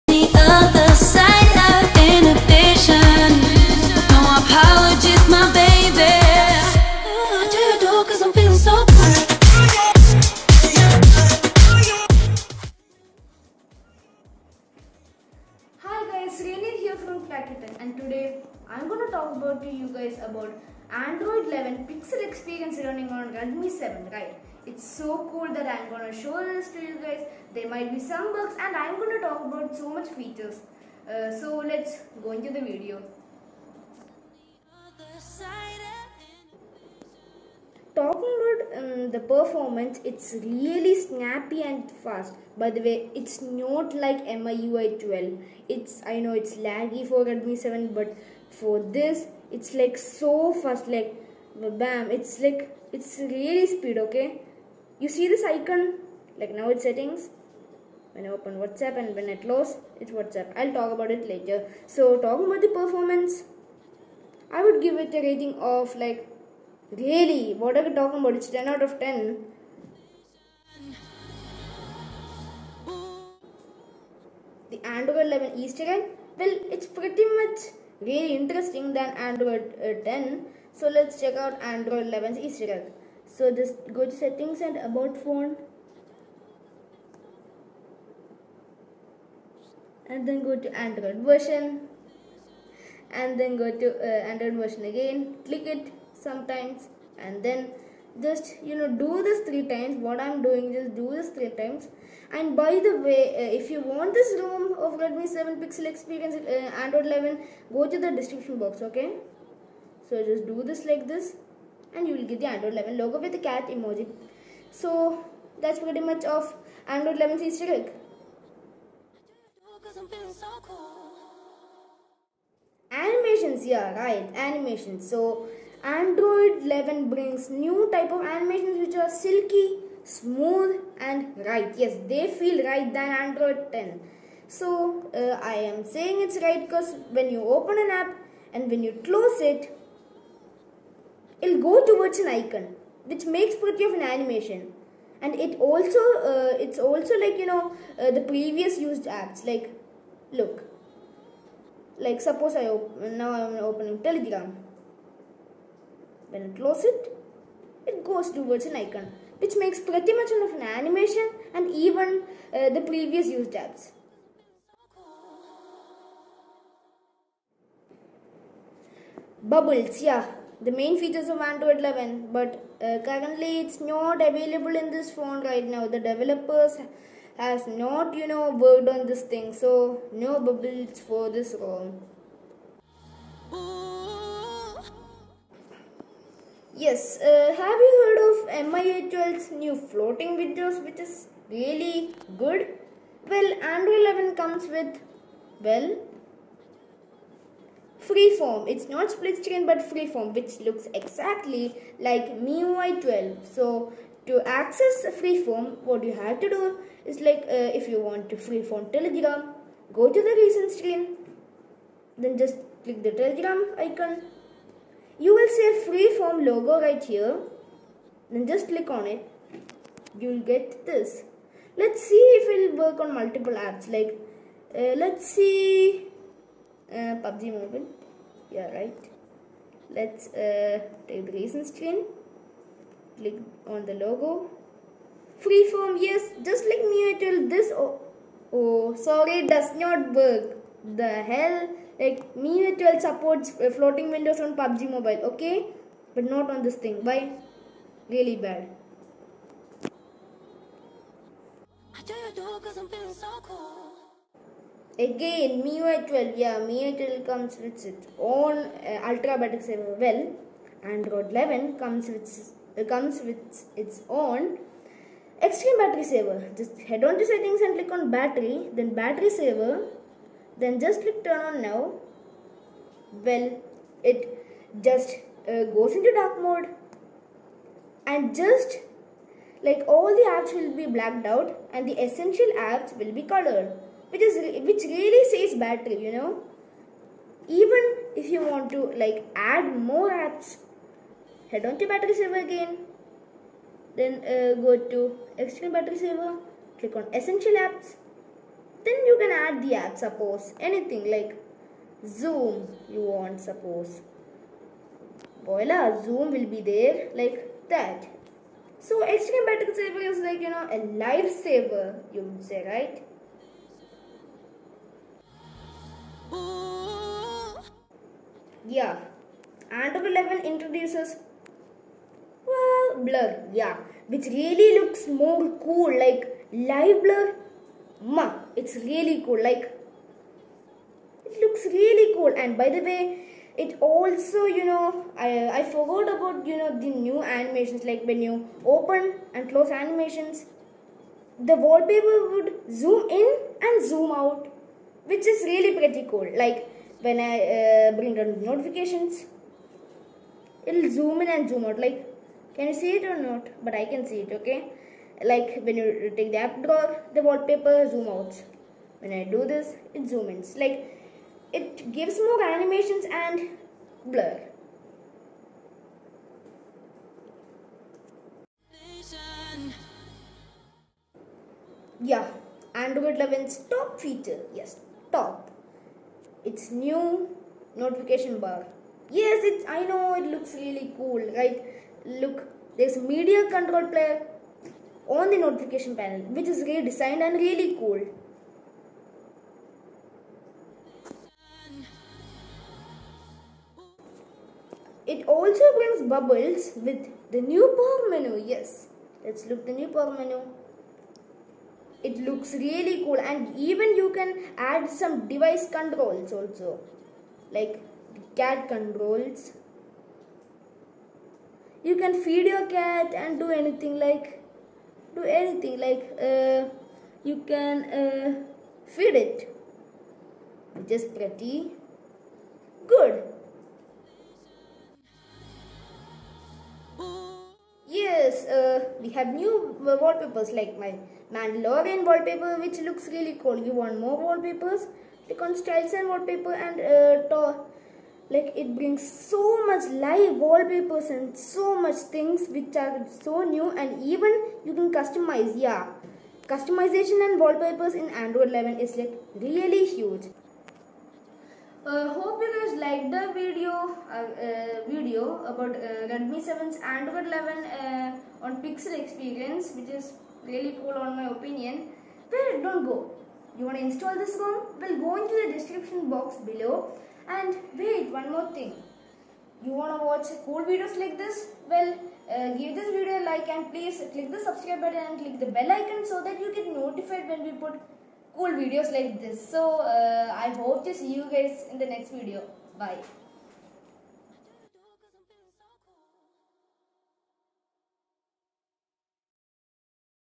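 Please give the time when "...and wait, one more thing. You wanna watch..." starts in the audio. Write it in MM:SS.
07:47.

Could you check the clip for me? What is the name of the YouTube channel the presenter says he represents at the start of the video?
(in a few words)
Kracky Tech.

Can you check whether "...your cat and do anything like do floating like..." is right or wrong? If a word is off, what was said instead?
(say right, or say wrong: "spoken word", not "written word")
wrong: "anything", not "floating".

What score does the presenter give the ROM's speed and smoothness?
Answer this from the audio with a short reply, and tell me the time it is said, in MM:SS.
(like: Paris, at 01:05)
10 out of 10, at 01:08.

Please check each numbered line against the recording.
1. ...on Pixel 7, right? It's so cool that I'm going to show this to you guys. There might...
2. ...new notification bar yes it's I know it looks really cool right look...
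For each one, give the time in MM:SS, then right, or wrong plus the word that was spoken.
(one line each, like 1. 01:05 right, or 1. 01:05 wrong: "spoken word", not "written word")
1. 00:23 wrong: "Redmi", not "Pixel"
2. 06:16 right.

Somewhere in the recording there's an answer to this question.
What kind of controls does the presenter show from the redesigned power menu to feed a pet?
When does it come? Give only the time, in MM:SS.
06:48.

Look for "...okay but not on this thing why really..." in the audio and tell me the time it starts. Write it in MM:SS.
04:05.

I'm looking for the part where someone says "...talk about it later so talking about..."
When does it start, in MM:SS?
01:00.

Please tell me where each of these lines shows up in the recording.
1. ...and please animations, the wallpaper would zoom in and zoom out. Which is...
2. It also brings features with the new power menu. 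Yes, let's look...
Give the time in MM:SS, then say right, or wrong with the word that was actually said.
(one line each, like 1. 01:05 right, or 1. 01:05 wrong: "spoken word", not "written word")
1. 05:39 wrong: "close", not "please"
2. 06:35 wrong: "bubbles", not "features".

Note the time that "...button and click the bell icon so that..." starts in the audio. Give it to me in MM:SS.
07:54.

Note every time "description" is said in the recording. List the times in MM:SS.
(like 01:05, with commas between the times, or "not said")
01:48, 07:45.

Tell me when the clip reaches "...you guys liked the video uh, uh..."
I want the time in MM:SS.
07:32.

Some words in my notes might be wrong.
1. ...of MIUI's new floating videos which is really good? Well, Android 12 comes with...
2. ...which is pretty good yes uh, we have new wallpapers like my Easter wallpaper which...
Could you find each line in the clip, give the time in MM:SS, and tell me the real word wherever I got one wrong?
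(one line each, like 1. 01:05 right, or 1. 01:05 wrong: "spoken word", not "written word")
1. 03:08 wrong: "11", not "12"
2. 07:00 wrong: "Mandalorian", not "Easter".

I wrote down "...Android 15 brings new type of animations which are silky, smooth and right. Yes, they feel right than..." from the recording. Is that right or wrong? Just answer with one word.
wrong.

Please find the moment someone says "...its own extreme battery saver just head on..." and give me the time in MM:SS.
04:23.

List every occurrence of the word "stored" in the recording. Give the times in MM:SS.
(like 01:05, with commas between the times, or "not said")
not said.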